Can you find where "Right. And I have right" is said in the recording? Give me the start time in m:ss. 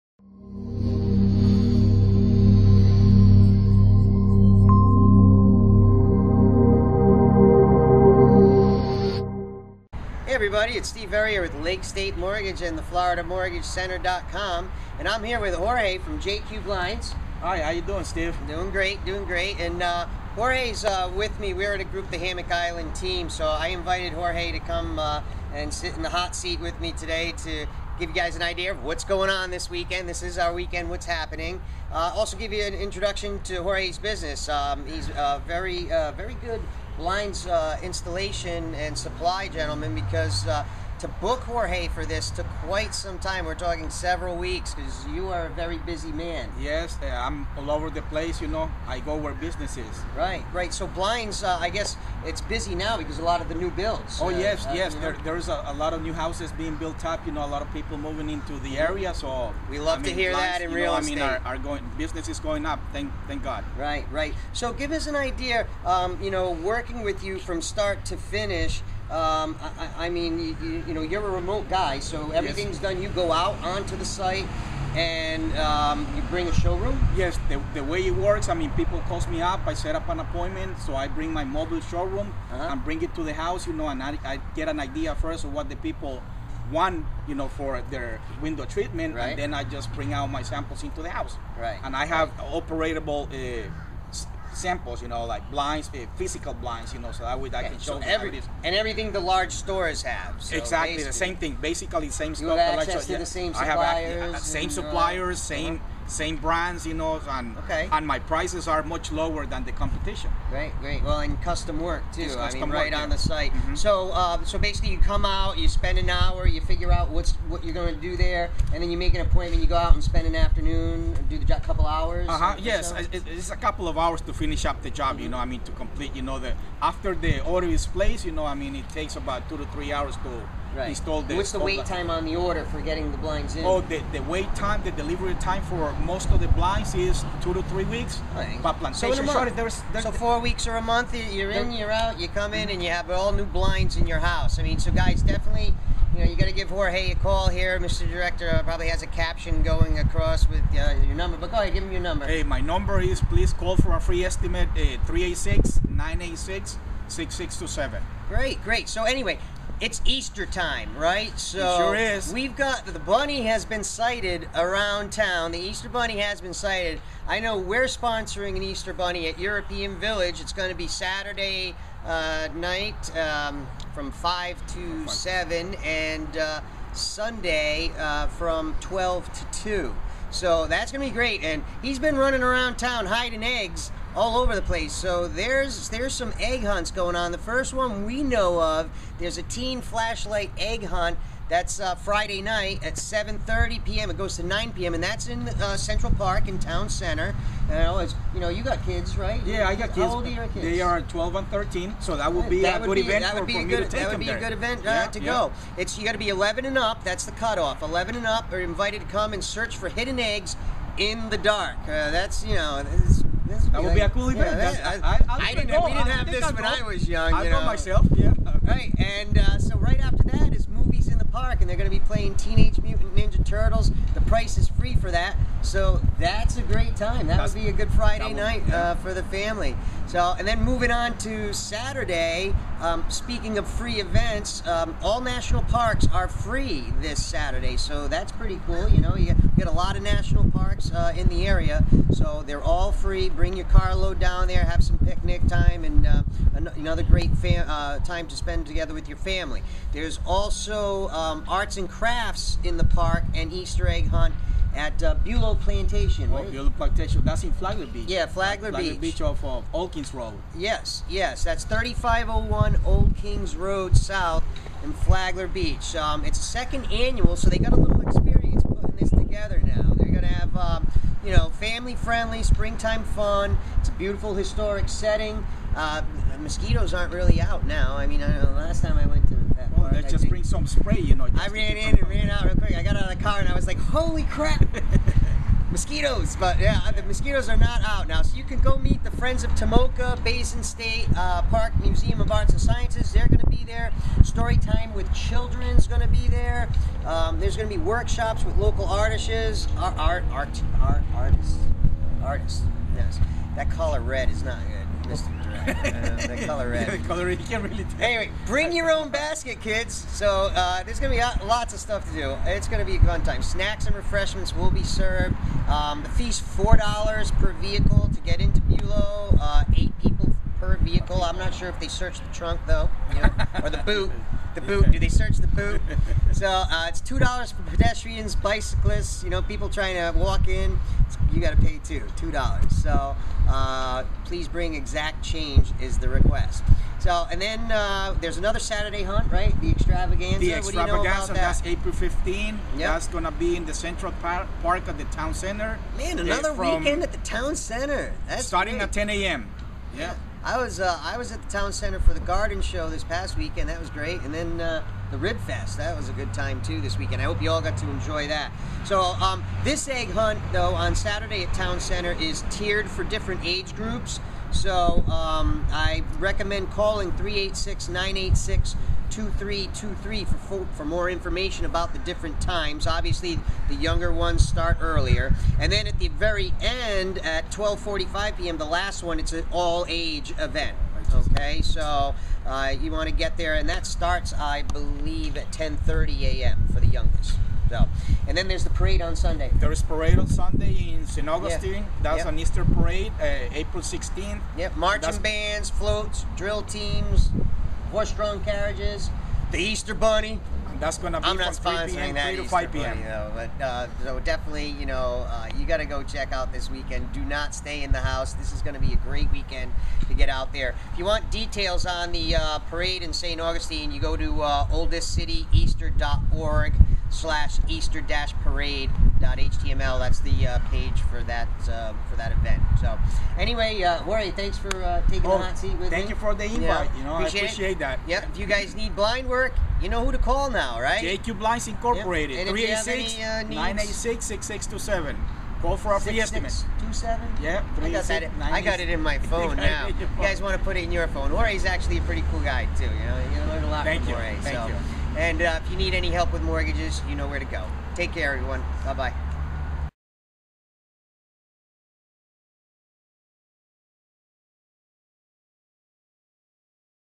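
1:31.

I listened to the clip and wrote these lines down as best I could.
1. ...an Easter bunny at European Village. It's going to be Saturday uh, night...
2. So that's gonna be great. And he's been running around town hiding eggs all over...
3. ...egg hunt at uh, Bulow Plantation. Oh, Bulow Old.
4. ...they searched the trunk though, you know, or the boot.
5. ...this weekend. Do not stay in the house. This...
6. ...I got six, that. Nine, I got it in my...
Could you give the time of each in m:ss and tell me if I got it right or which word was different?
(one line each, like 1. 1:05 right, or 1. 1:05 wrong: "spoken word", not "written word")
1. 2:48 right
2. 3:00 right
3. 4:13 wrong: "Plantation", not "Old"
4. 5:21 right
5. 6:46 right
6. 7:17 right.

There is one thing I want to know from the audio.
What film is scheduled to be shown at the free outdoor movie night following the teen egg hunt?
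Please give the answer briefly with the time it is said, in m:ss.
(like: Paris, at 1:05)
Teenage Mutant Ninja Turtles, at 3:42.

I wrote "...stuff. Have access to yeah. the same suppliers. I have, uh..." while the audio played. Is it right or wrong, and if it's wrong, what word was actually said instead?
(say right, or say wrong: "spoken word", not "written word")
right.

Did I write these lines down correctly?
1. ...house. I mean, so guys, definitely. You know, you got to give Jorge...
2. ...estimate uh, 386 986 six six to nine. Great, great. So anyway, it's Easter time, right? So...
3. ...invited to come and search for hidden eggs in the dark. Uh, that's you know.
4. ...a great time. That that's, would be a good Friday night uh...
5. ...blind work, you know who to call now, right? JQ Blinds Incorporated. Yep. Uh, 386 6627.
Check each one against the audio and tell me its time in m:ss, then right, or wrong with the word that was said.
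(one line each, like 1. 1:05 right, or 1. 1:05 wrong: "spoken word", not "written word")
1. 2:24 right
2. 2:34 wrong: "seven", not "nine"
3. 3:28 right
4. 3:46 right
5. 7:08 right.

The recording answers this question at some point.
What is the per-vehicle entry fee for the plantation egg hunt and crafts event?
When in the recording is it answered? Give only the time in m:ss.
5:16.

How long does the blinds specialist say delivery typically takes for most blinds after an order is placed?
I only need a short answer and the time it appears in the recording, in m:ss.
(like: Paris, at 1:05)
2 to 3 weeks, at 2:17.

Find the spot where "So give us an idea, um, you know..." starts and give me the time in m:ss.
1:04.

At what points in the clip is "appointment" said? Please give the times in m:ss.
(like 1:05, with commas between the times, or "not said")
1:20, 1:59.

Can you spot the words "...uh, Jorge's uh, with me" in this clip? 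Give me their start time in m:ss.
0:19.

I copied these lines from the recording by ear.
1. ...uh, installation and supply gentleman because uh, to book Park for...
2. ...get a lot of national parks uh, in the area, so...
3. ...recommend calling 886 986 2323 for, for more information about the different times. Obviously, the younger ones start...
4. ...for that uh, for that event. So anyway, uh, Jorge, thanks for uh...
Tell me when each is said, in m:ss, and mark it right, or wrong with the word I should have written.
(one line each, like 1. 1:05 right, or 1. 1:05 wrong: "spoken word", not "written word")
1. 0:37 wrong: "Jorge", not "Park"
2. 3:59 right
3. 6:06 wrong: "386", not "886"
4. 7:01 right.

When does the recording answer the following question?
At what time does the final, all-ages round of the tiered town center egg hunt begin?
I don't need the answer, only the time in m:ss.
6:17.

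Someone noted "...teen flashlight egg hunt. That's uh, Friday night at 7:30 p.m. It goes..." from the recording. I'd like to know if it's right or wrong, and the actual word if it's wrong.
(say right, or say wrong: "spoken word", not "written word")
right.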